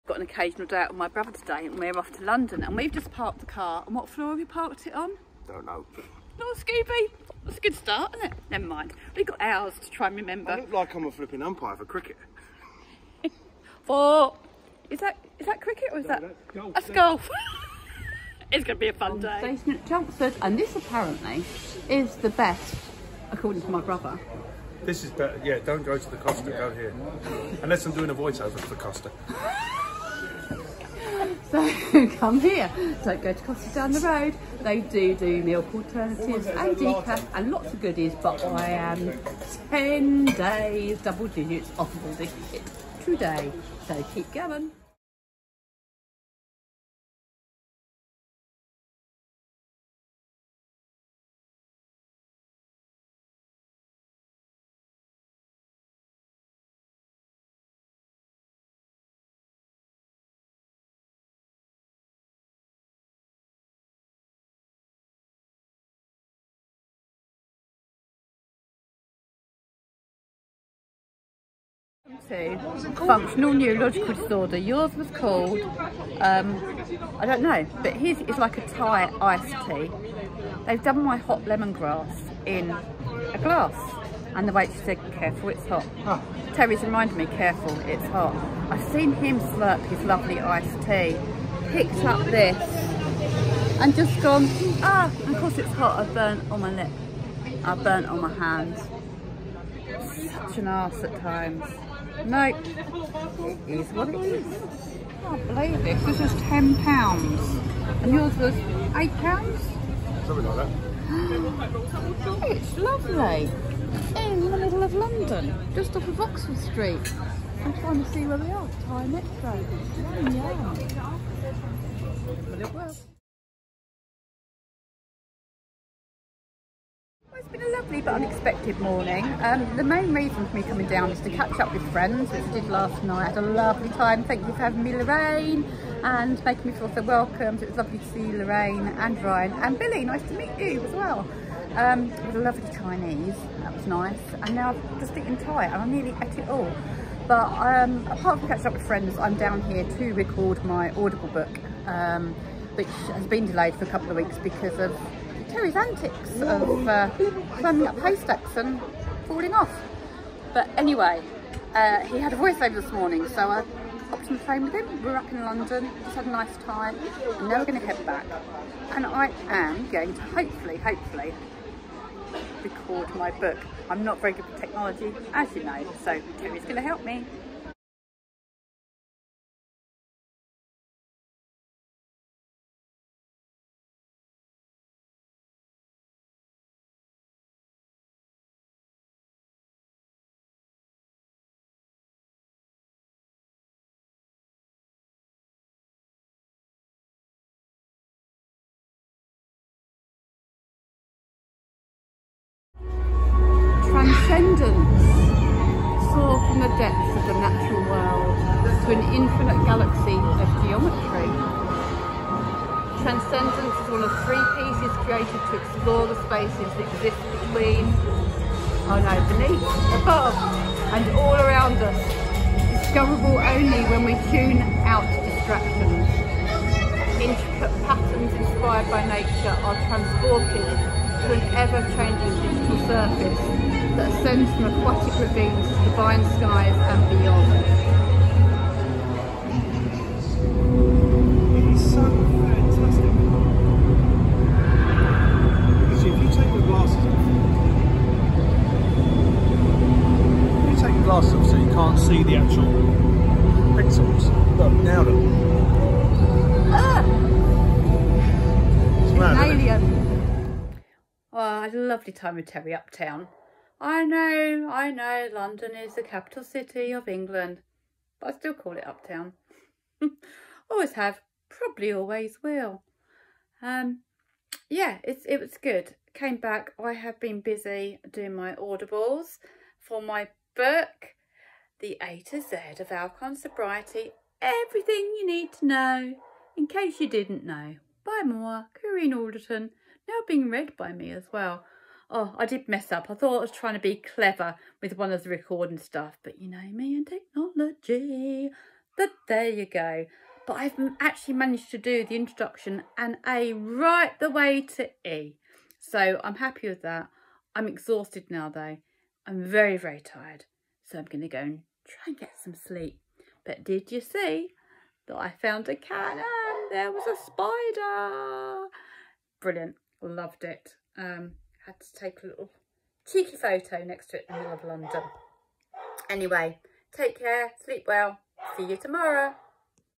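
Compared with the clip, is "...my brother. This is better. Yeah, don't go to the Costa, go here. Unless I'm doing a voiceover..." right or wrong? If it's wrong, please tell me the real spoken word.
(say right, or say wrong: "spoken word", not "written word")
right.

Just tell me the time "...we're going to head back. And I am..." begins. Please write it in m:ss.
2:47.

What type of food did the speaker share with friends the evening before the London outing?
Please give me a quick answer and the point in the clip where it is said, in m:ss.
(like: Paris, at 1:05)
Chinese, at 2:22.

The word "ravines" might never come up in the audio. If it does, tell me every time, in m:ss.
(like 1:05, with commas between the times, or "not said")
3:55.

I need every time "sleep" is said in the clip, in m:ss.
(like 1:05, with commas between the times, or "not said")
5:12, 5:27.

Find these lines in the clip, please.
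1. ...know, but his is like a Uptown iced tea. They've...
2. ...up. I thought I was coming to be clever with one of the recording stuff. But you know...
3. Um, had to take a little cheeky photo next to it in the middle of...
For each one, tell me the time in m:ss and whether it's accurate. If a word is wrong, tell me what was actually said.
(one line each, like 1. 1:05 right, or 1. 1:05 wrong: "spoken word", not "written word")
1. 1:17 wrong: "Thai", not "Uptown"
2. 4:52 wrong: "trying", not "coming"
3. 5:20 right.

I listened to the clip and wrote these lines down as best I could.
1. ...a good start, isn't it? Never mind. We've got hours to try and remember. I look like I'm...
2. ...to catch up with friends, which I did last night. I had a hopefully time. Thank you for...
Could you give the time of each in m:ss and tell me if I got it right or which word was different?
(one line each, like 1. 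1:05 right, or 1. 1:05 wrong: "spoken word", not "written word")
1. 0:07 right
2. 2:11 wrong: "lovely", not "hopefully".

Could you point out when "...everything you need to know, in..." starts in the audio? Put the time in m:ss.
4:44.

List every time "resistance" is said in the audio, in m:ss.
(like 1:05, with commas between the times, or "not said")
not said.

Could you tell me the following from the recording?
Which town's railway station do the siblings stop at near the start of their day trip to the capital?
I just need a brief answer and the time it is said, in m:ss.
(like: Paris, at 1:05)
Chelmsford, at 0:19.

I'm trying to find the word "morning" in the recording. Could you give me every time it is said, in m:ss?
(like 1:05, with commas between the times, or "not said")
2:08, 2:42.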